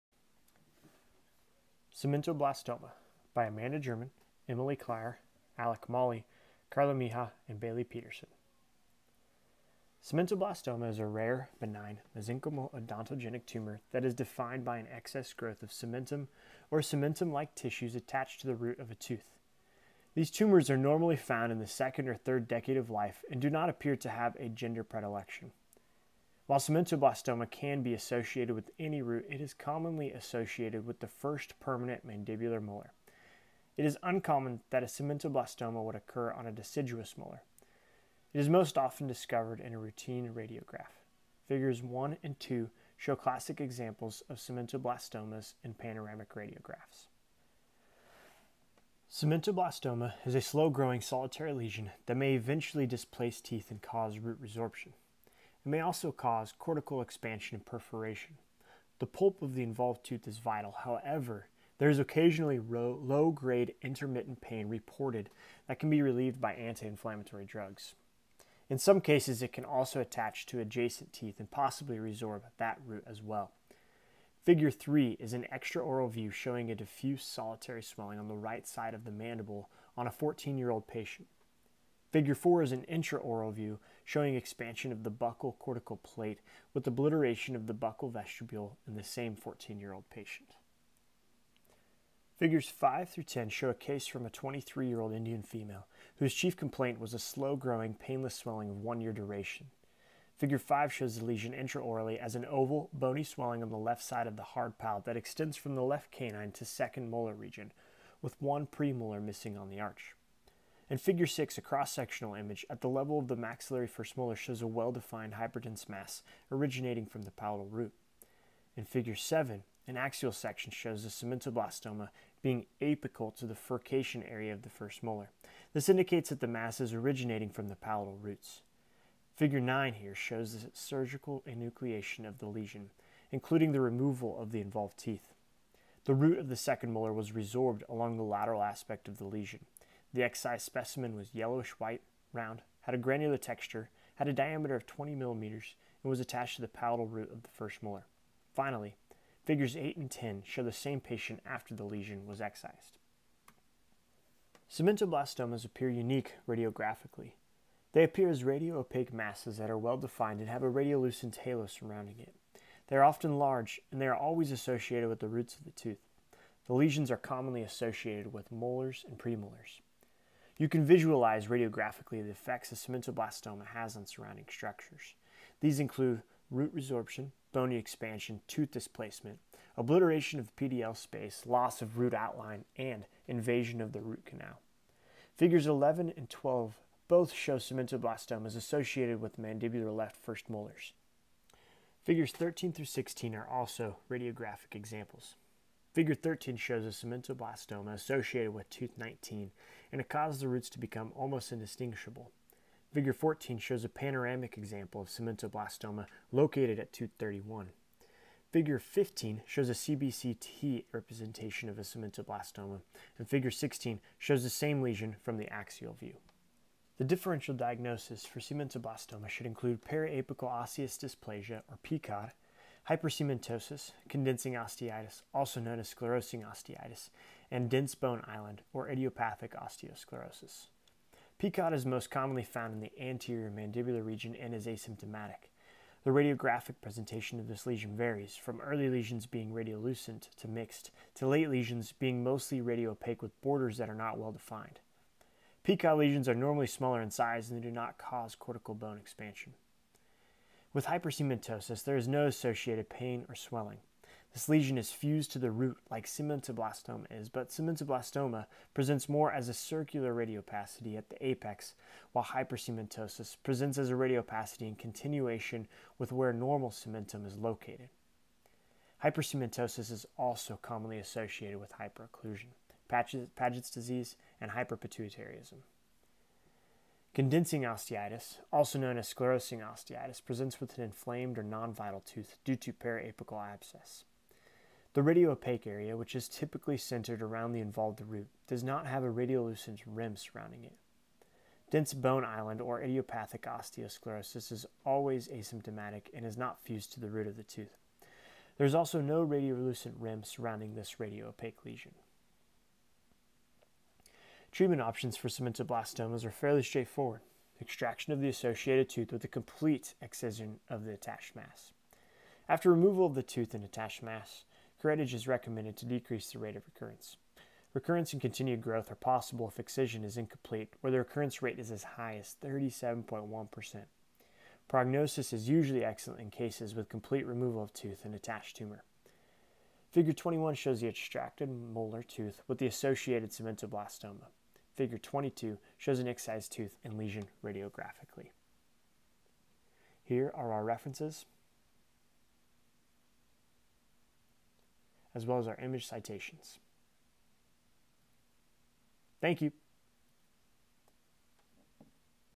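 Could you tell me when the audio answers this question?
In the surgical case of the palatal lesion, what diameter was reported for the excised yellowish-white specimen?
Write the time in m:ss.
2:24.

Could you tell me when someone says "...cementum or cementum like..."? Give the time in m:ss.
0:15.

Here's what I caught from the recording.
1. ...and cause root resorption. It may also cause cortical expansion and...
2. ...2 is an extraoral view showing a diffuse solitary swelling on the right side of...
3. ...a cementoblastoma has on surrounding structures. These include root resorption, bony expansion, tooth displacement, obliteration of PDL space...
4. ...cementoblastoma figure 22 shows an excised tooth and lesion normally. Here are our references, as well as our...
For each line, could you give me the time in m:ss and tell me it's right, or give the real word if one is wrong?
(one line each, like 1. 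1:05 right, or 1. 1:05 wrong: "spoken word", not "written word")
1. 0:53 right
2. 1:14 wrong: "3", not "2"
3. 2:52 right
4. 5:33 wrong: "radiographically", not "normally".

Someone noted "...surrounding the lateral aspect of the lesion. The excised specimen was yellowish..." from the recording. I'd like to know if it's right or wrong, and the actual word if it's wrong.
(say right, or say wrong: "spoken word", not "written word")
wrong: "along", not "surrounding".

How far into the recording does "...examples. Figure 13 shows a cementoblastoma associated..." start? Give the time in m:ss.
3:14.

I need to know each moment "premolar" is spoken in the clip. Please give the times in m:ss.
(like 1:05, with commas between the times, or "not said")
1:48, 2:49.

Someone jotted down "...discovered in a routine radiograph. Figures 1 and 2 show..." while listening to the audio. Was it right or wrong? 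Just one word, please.
right.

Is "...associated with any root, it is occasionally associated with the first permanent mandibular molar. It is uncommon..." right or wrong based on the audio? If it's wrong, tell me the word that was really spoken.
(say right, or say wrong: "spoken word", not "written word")
wrong: "commonly", not "occasionally".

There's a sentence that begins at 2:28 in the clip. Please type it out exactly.
Finally, figures 8 and 10 show the same patient after the lesion was excised.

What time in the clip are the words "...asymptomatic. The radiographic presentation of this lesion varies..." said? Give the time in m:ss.
3:54.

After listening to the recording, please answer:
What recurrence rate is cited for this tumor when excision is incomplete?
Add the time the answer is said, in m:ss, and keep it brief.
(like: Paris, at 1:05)
37.1%, at 5:22.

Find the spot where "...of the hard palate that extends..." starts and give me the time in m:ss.
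1:44.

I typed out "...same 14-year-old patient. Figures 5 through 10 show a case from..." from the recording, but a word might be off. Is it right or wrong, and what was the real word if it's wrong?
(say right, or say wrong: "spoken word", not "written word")
right.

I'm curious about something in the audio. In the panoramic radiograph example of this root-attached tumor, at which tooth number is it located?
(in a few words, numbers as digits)
31.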